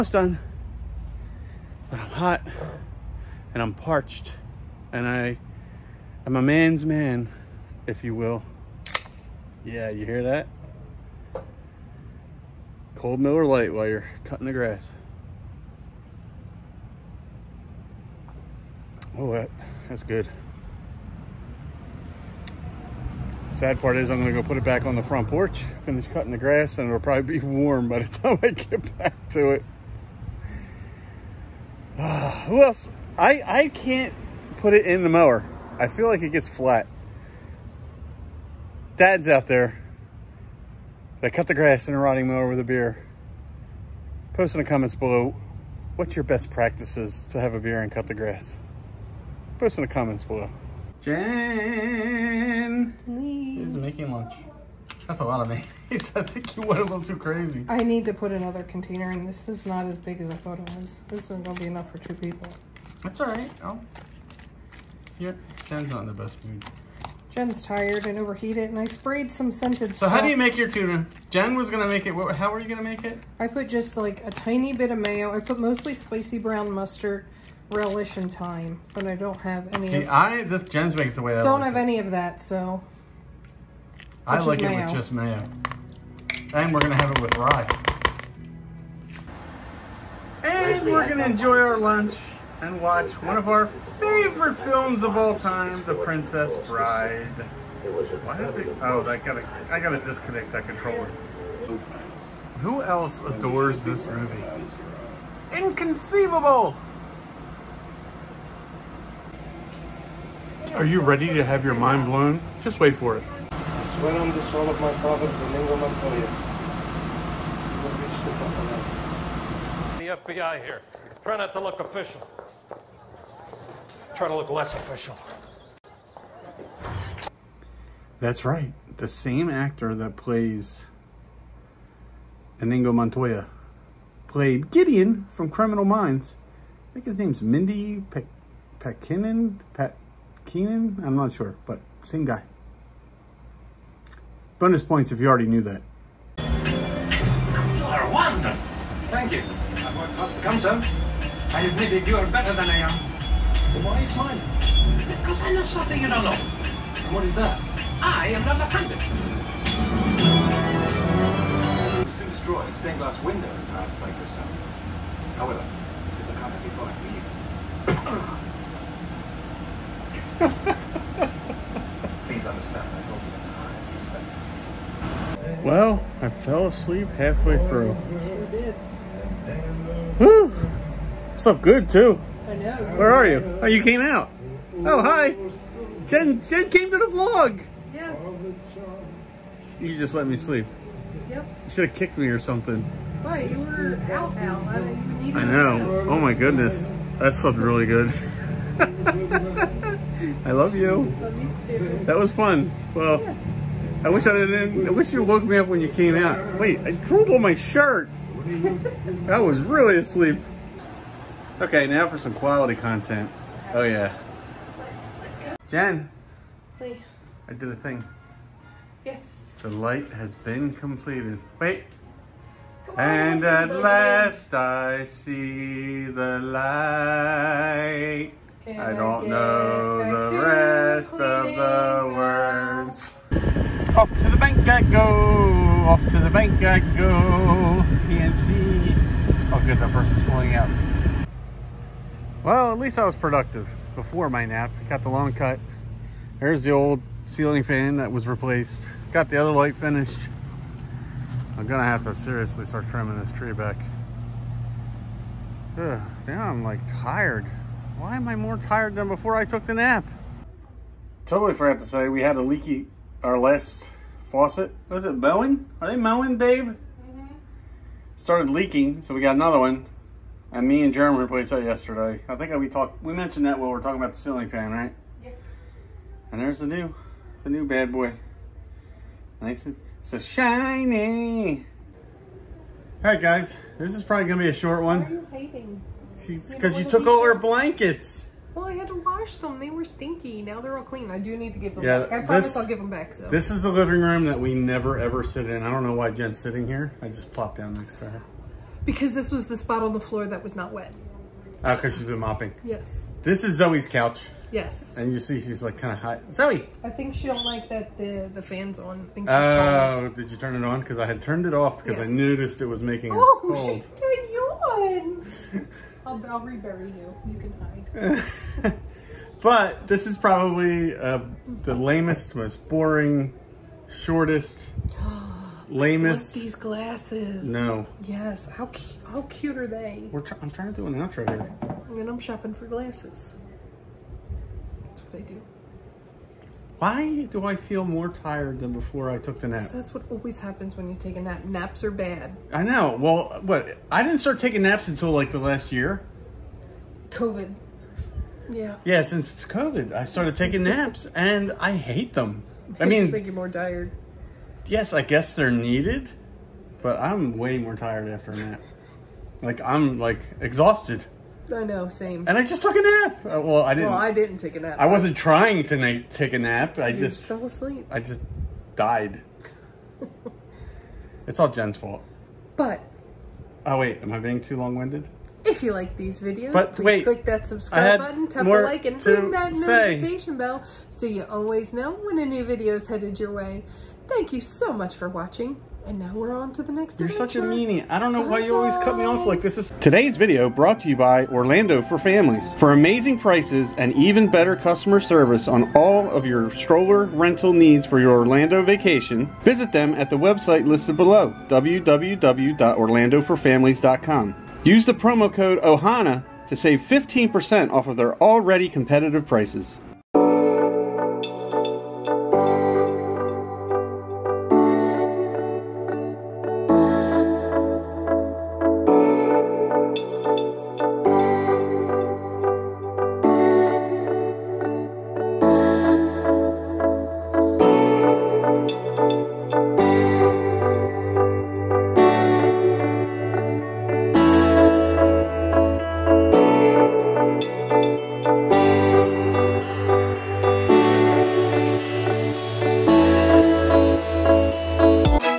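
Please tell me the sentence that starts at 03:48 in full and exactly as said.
Can I don't I know the rest of the words.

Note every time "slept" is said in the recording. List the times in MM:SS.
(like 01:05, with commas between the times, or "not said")
03:01, 03:17.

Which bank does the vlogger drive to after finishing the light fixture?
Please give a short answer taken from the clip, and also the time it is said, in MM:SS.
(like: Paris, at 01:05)
PNC, at 03:58.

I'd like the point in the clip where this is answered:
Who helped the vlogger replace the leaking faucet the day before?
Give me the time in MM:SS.
04:30.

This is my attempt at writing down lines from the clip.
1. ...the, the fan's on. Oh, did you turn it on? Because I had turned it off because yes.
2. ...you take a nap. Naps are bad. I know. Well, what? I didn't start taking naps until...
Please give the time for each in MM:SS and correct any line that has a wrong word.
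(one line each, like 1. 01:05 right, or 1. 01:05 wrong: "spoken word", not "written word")
1. 05:07 right
2. 05:40 right.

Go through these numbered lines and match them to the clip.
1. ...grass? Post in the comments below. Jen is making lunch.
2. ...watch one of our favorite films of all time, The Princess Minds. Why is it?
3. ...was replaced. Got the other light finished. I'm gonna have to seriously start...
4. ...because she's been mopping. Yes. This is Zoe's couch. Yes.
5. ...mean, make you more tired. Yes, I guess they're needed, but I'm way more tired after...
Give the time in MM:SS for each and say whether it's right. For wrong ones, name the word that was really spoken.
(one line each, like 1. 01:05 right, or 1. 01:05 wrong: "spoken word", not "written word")
1. 00:48 right
2. 01:32 wrong: "Bride", not "Minds"
3. 04:08 right
4. 05:01 right
5. 05:52 right.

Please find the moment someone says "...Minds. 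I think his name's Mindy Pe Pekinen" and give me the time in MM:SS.
02:15.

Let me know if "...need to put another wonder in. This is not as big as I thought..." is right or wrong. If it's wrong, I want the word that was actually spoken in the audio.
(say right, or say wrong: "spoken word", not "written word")
wrong: "container", not "wonder".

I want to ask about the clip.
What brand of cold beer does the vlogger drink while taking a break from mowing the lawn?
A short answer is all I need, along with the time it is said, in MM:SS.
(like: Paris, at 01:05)
Miller Lite, at 00:13.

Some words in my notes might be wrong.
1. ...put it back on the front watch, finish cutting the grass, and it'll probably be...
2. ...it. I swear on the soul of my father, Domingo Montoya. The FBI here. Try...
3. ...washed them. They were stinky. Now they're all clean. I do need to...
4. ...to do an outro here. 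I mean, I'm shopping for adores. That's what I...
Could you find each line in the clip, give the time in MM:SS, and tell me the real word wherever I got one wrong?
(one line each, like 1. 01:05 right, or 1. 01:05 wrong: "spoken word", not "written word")
1. 00:24 wrong: "porch", not "watch"
2. 01:53 right
3. 04:49 right
4. 05:30 wrong: "glasses", not "adores".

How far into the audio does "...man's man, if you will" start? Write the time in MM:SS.
00:06.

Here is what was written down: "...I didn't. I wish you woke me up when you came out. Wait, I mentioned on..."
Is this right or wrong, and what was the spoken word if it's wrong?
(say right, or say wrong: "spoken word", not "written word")
wrong: "drooled", not "mentioned".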